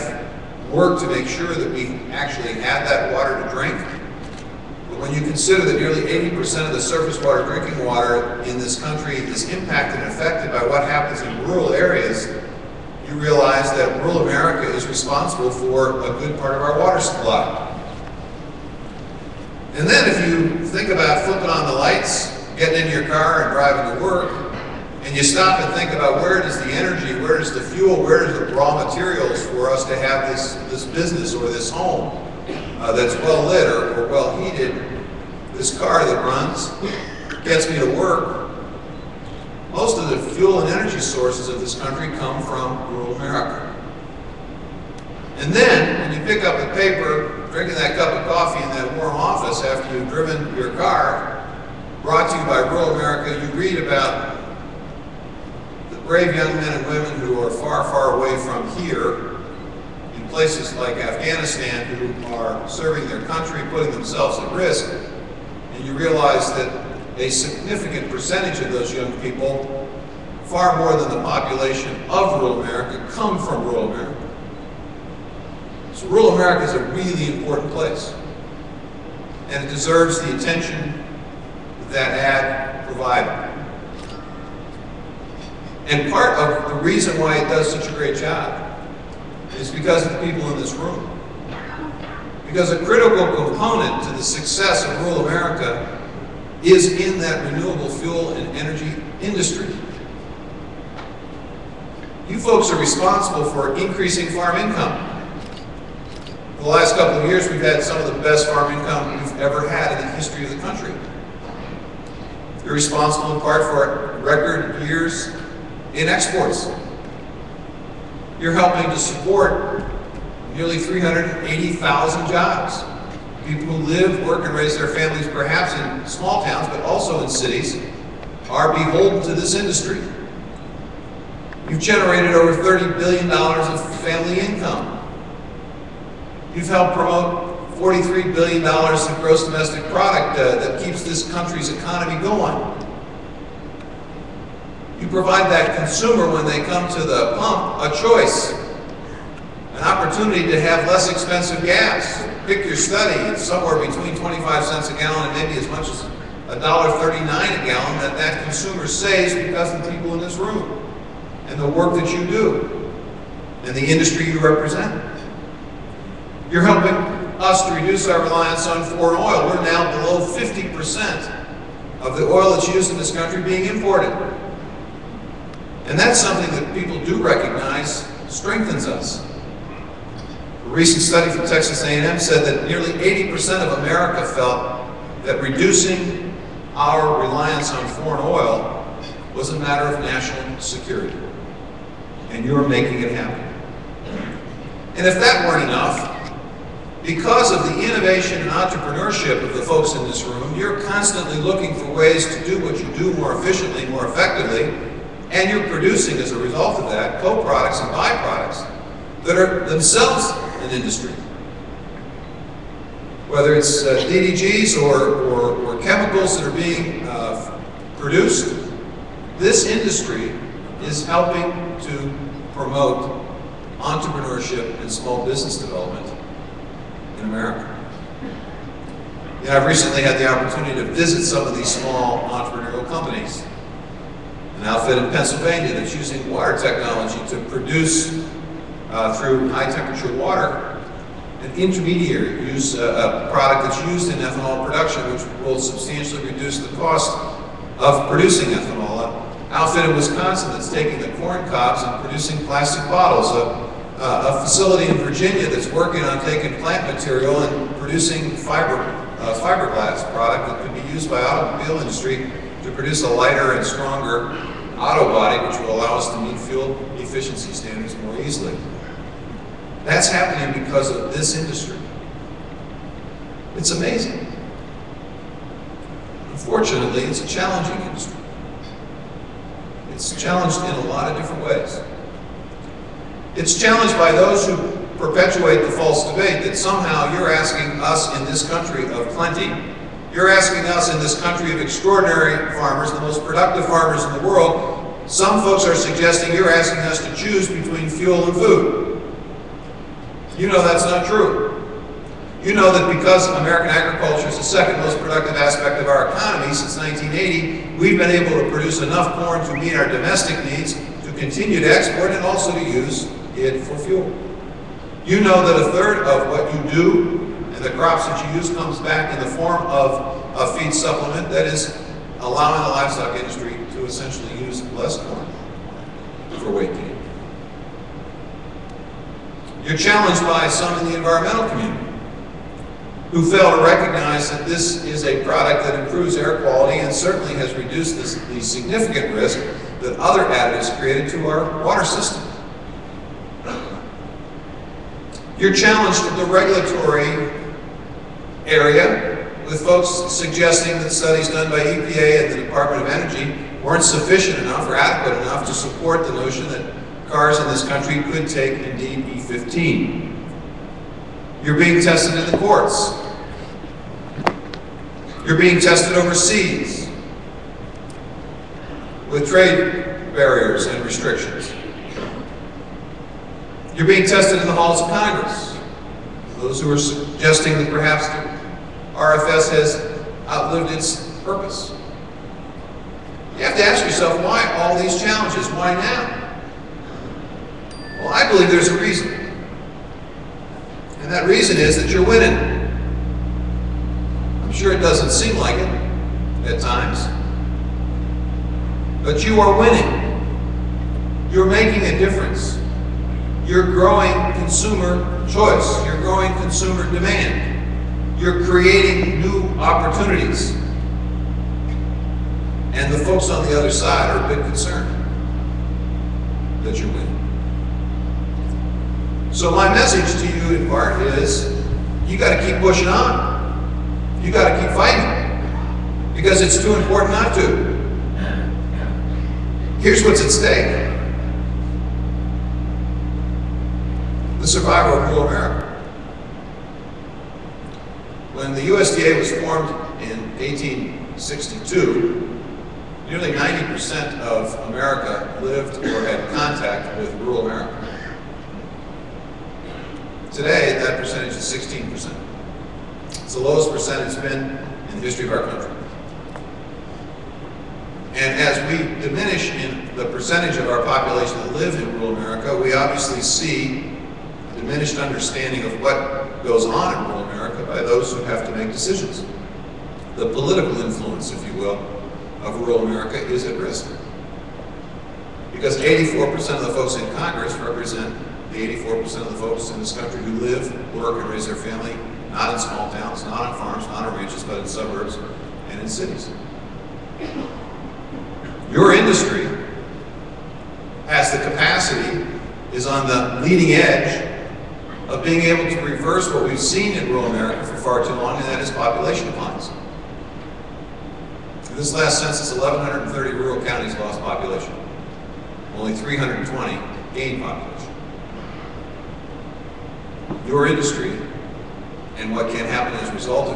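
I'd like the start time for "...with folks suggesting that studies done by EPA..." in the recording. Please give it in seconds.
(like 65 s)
349 s.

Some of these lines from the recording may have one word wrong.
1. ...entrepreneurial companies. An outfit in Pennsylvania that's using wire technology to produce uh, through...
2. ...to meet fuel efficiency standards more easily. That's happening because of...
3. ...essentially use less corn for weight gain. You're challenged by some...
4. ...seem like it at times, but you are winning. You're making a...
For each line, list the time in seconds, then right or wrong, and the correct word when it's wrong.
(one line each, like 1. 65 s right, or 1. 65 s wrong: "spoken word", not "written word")
1. 232 s right
2. 266 s right
3. 323 s right
4. 395 s right.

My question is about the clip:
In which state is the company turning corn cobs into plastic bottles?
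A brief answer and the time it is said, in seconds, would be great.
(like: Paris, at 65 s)
Wisconsin, at 249 s.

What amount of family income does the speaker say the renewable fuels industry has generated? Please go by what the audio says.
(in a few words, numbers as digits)
Over $30 billion.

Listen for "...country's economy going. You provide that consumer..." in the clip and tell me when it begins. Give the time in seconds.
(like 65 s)
141 s.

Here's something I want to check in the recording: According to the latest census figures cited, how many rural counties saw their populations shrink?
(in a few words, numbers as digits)
1,130.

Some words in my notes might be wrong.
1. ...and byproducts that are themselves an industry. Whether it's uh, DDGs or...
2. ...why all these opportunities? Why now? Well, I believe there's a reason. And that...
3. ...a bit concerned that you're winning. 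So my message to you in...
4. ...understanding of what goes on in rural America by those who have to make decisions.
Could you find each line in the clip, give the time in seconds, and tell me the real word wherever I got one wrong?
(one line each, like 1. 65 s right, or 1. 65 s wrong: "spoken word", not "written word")
1. 207 s right
2. 384 s wrong: "challenges", not "opportunities"
3. 414 s right
4. 464 s right.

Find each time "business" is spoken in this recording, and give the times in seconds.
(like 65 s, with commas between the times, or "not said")
30 s, 225 s.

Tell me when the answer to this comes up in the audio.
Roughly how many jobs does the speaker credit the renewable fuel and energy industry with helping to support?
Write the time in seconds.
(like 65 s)
120 s.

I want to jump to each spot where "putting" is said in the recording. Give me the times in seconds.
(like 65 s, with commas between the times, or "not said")
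63 s.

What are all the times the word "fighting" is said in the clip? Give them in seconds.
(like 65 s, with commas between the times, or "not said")
424 s.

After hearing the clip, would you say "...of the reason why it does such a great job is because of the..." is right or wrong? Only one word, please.
right.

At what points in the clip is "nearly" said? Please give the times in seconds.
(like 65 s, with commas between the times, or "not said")
5 s, 120 s, 182 s, 443 s.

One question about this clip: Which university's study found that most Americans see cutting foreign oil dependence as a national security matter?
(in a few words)
Texas A&M.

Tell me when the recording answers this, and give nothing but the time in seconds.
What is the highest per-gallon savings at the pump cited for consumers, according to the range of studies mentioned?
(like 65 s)
156 s.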